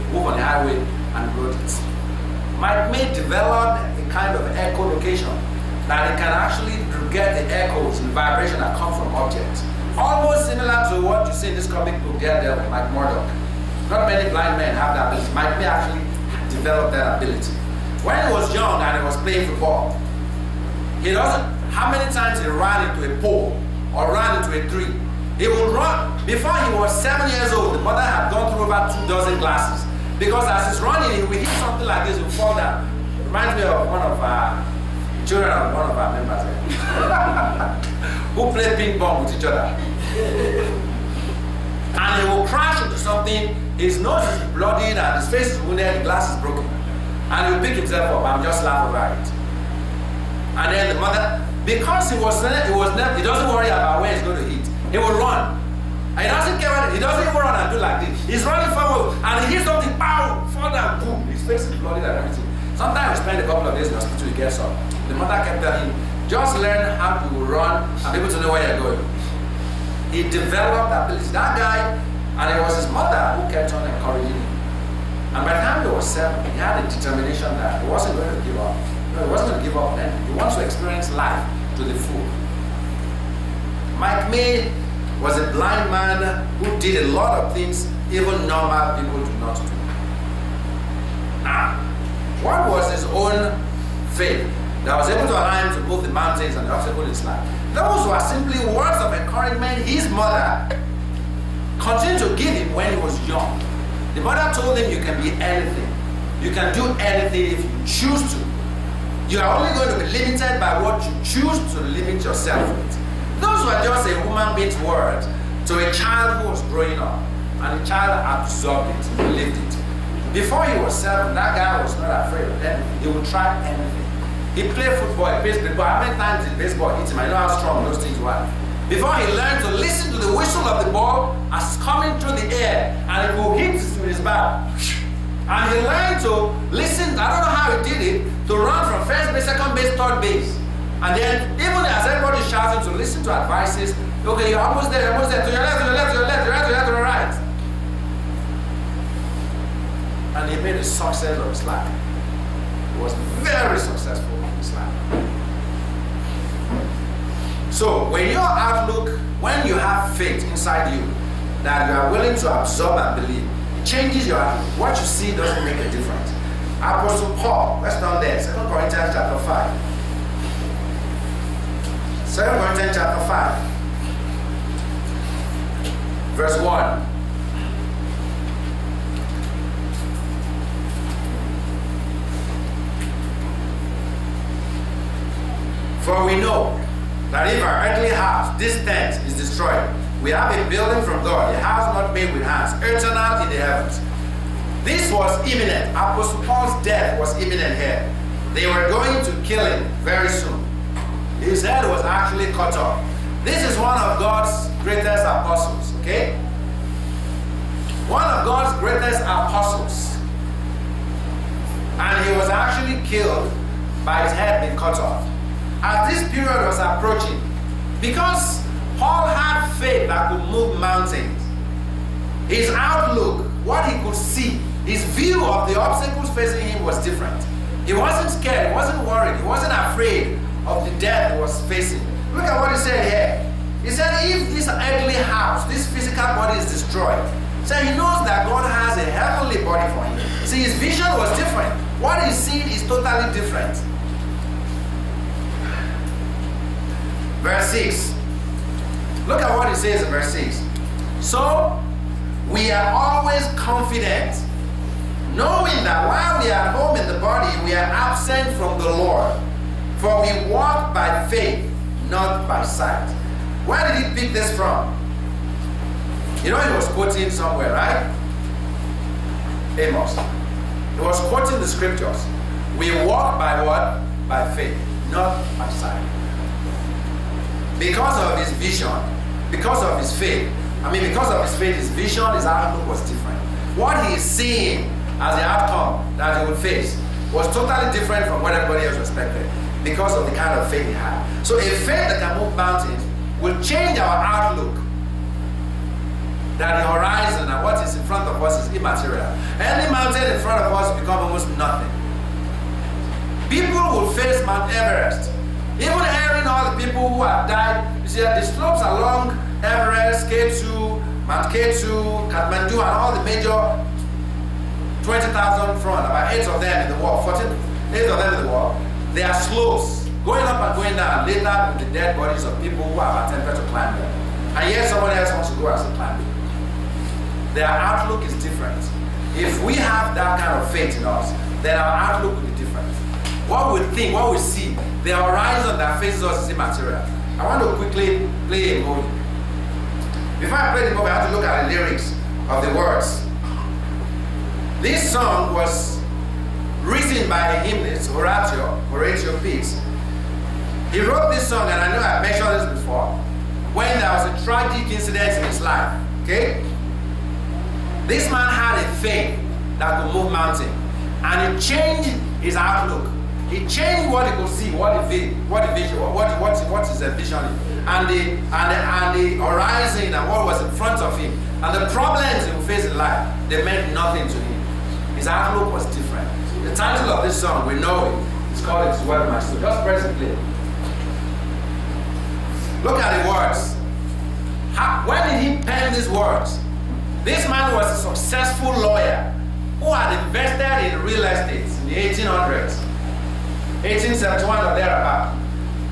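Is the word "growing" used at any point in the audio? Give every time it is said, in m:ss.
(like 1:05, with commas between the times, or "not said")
1:56.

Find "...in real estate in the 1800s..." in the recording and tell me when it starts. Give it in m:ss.
6:30.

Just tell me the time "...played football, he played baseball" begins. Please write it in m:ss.
2:04.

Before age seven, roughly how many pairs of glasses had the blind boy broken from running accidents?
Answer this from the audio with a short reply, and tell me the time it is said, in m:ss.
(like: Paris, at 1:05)
2 dozen, at 0:28.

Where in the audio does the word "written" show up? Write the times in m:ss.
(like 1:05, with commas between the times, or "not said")
5:46.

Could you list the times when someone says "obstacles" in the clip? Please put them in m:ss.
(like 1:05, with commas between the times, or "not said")
1:36, 3:45.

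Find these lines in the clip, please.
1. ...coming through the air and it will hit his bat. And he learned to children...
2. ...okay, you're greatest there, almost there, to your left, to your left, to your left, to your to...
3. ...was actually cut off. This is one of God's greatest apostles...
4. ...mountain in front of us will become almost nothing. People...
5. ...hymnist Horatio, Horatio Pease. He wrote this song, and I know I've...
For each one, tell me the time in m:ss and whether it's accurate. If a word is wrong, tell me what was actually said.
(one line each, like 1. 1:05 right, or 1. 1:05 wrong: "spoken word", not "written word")
1. 2:11 wrong: "listen", not "children"
2. 2:24 wrong: "almost", not "greatest"
3. 3:21 right
4. 4:59 right
5. 5:47 right.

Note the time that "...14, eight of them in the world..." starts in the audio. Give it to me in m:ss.
5:17.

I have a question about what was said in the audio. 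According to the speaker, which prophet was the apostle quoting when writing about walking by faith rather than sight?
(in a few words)
Amos.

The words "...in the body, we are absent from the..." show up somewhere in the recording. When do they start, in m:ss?
4:16.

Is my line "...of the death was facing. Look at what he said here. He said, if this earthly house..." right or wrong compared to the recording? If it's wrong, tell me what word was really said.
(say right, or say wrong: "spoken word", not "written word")
right.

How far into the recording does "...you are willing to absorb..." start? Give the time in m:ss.
2:41.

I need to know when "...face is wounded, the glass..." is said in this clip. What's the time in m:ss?
0:45.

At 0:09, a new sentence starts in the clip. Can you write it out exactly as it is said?
Almost similar to what you see in this comic book, Daredevil, Mike Murdock.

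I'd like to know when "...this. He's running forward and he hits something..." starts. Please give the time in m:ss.
0:57.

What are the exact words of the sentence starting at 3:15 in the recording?
Apostle Paul's death was imminent here.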